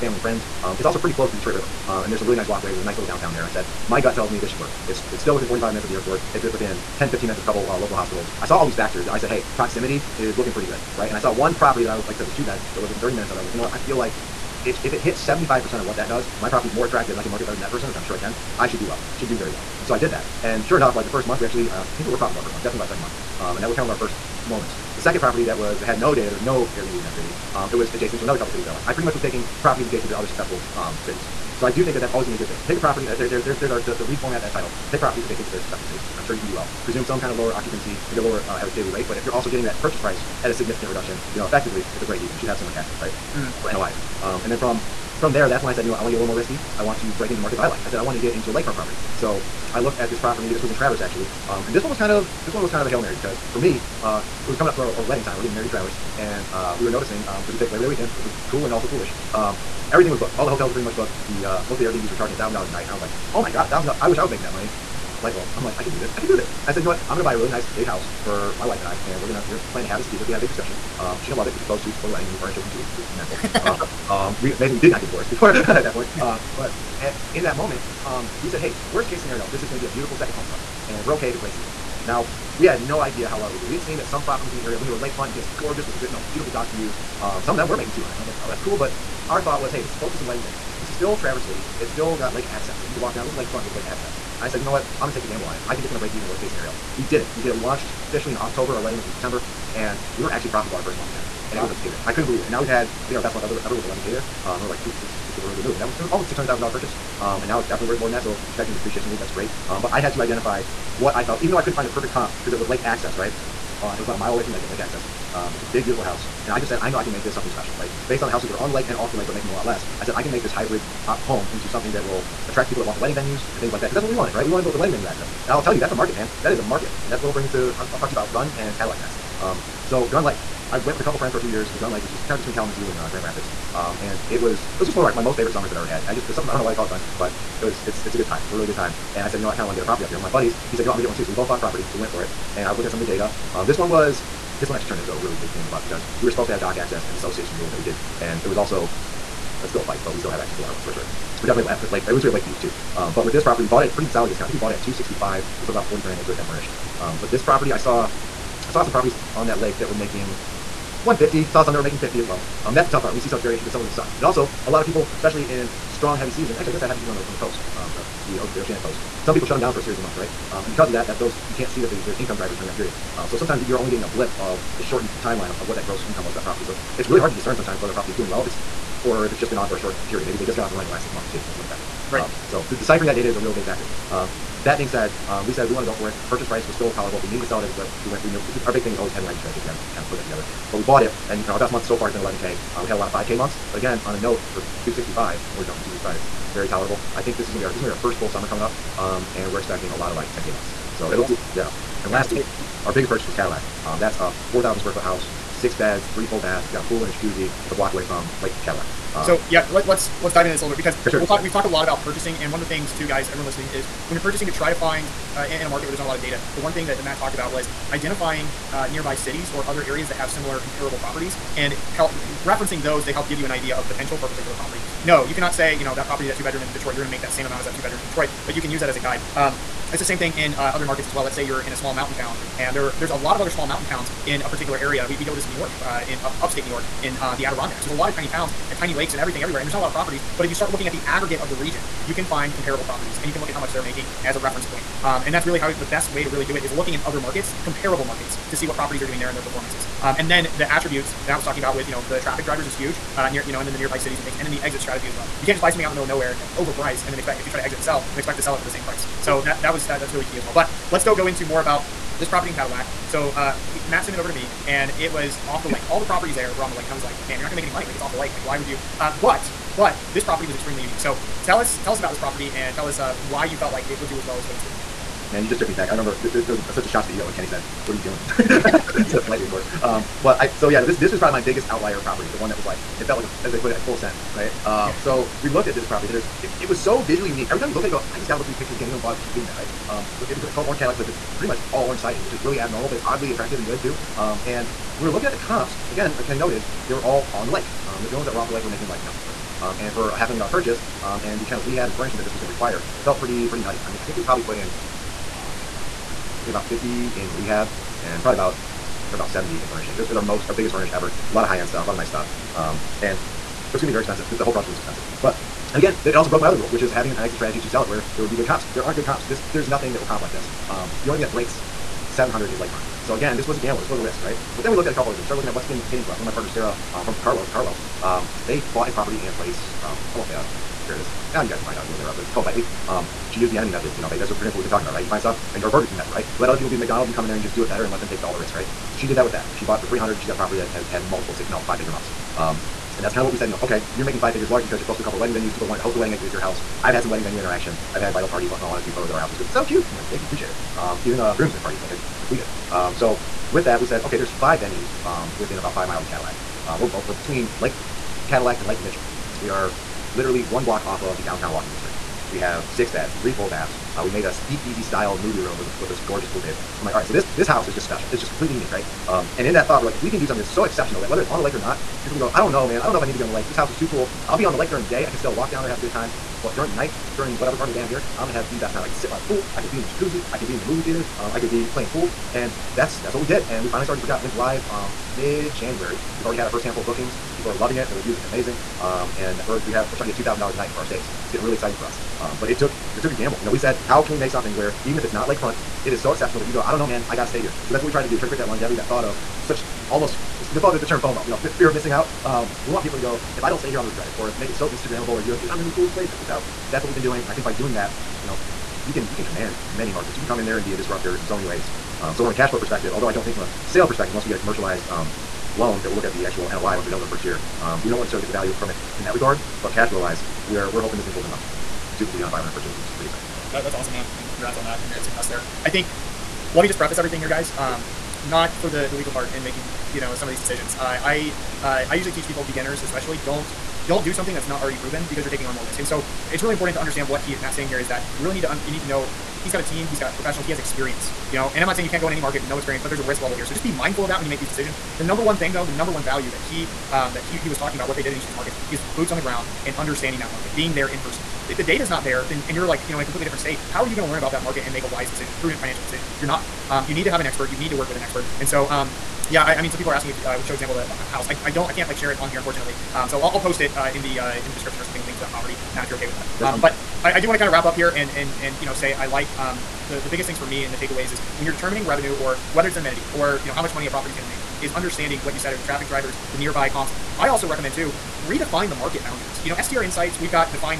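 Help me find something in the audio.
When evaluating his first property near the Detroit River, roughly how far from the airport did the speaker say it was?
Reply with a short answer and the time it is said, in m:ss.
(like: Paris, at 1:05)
45 minutes, at 0:05.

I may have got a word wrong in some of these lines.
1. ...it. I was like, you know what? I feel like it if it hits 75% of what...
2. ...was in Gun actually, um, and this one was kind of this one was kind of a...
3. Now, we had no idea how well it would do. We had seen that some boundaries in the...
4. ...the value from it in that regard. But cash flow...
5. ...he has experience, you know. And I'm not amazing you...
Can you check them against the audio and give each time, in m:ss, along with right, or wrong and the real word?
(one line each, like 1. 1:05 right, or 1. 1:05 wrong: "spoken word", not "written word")
1. 0:13 right
2. 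0:50 wrong: "Traverse", not "Gun"
3. 1:22 wrong: "properties", not "boundaries"
4. 6:58 right
5. 7:20 wrong: "saying", not "amazing".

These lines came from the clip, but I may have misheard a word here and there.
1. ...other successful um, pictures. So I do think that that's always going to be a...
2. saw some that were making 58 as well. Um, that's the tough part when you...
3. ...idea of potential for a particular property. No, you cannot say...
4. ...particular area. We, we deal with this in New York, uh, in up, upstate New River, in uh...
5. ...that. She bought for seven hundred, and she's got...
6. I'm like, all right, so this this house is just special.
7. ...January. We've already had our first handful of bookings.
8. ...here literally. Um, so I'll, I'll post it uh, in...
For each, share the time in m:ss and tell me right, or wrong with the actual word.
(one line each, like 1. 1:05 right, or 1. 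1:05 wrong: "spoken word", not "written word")
1. 0:30 wrong: "cities", not "pictures"
2. 2:41 wrong: "50", not "58"
3. 3:43 right
4. 3:54 wrong: "York", not "River"
5. 5:39 wrong: "three", not "seven"
6. 6:06 right
7. 6:25 right
8. 7:42 wrong: "unfortunately", not "literally".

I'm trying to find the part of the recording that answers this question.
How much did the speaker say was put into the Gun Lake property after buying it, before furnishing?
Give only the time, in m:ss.
2:35.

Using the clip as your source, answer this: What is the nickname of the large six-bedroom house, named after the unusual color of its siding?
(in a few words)
Orange Cadillac.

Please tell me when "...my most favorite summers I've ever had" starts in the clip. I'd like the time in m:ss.
2:15.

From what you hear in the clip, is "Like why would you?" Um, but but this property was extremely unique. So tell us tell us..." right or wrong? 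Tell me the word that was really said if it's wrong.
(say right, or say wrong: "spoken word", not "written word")
right.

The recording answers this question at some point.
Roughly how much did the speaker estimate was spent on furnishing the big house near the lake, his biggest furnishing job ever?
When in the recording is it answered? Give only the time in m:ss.
5:09.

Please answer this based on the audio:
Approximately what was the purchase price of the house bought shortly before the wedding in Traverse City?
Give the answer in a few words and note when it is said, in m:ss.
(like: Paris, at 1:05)
$600,000, at 1:46.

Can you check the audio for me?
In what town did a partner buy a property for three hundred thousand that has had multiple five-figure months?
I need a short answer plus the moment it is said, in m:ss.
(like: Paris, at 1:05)
Bitely, at 5:32.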